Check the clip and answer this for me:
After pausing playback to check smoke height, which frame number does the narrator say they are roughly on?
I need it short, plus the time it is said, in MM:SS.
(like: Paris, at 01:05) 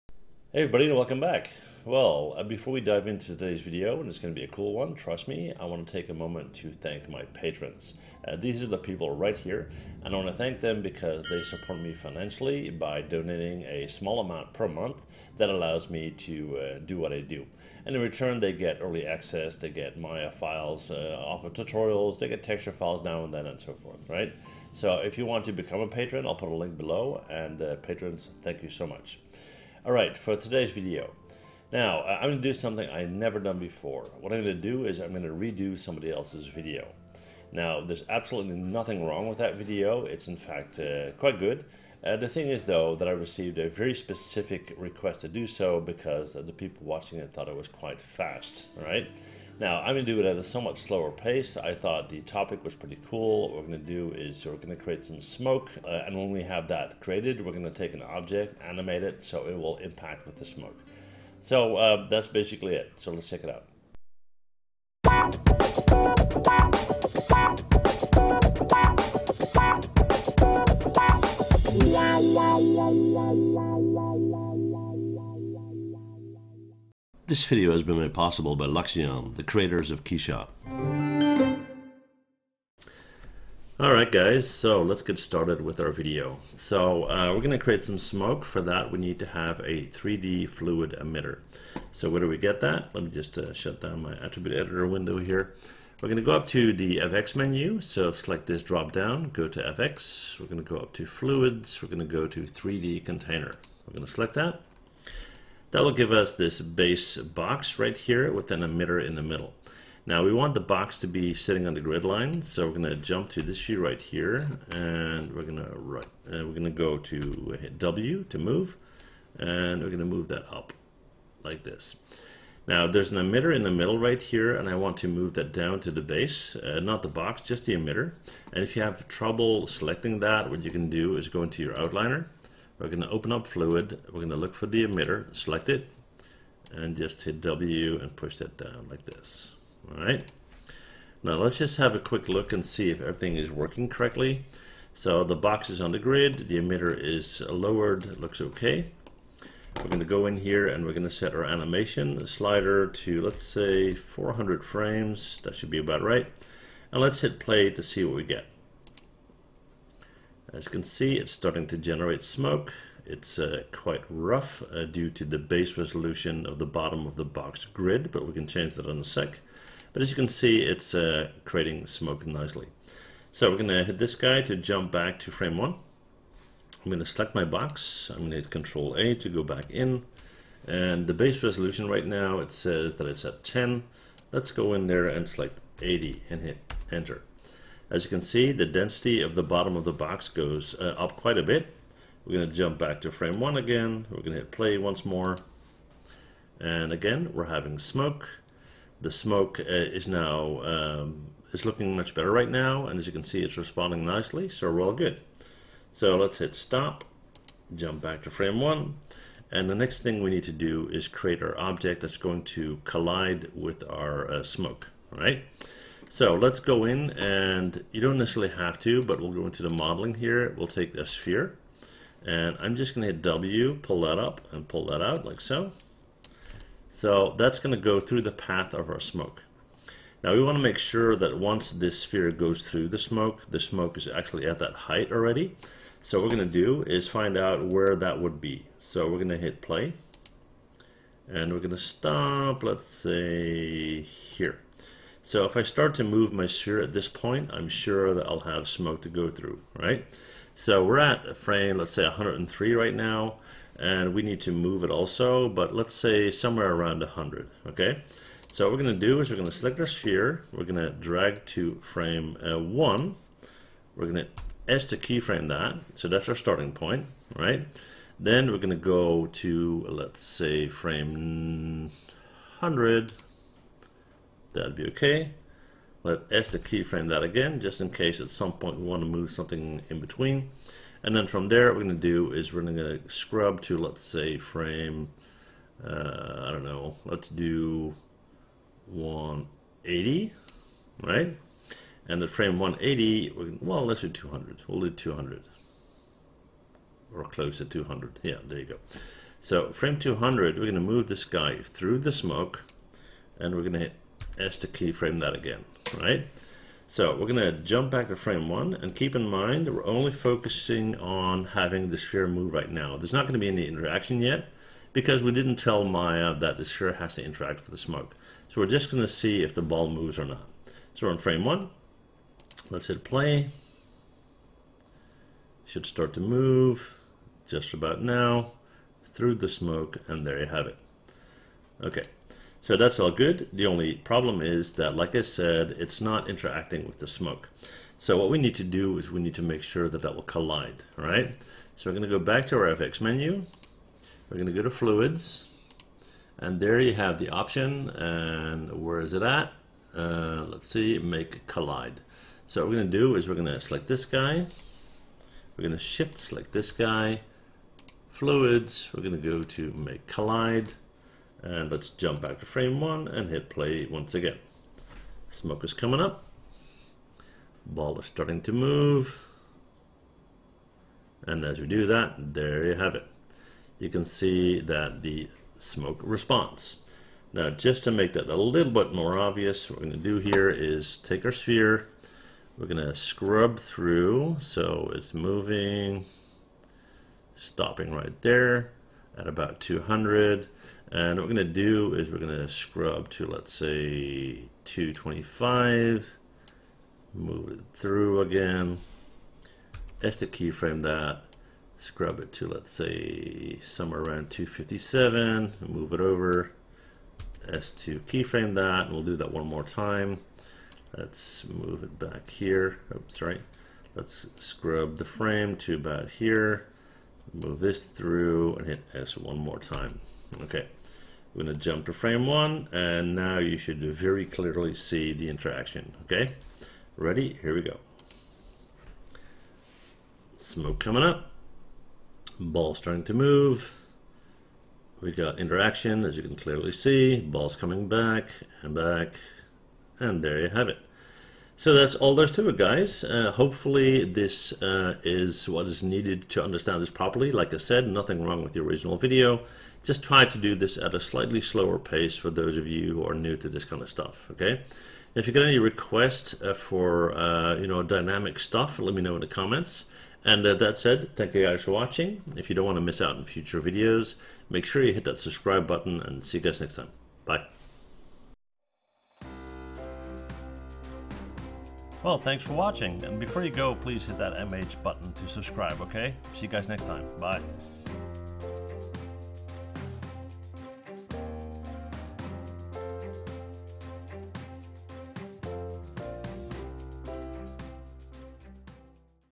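103, at 04:12.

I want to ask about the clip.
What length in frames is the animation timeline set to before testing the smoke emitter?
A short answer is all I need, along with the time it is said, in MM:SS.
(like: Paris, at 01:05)
400, at 02:33.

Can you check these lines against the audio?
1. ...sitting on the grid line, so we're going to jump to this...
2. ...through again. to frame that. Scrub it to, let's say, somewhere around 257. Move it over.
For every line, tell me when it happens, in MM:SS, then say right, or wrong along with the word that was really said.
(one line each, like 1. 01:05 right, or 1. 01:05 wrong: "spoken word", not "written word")
1. 01:51 right
2. 06:37 wrong: "keyframe", not "frame".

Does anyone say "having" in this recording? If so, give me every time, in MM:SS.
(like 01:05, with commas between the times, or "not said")
03:17, 05:11.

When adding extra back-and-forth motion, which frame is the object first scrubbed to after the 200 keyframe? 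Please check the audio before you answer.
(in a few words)
225.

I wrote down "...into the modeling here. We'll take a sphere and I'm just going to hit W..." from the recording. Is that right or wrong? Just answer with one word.
right.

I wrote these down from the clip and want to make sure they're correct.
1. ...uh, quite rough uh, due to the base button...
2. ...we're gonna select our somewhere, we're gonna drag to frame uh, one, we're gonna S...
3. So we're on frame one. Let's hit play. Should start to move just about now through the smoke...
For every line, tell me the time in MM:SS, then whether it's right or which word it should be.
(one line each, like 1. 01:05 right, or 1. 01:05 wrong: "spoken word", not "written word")
1. 02:43 wrong: "resolution", not "button"
2. 04:19 wrong: "sphere", not "somewhere"
3. 05:20 right.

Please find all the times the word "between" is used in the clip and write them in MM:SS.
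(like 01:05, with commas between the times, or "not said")
04:39.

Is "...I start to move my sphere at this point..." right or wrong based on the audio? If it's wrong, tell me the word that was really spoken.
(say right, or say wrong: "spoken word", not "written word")
right.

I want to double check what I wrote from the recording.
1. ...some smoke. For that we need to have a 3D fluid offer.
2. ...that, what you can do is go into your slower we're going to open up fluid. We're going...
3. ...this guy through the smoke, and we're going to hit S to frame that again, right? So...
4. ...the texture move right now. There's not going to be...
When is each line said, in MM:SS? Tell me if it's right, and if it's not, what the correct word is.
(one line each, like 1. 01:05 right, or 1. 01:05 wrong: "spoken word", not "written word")
1. 01:27 wrong: "emitter", not "offer"
2. 02:10 wrong: "outliner", not "slower"
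3. 05:01 wrong: "keyframe", not "frame"
4. 05:11 wrong: "sphere", not "texture".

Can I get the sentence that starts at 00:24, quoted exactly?
So if you want to become a patron, I'll put a link below, and uh, patrons, thank you so much.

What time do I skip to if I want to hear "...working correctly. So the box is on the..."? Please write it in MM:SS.
02:23.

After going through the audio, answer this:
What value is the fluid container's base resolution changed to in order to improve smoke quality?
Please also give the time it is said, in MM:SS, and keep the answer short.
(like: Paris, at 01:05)
80, at 03:05.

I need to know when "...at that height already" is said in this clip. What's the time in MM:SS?
03:54.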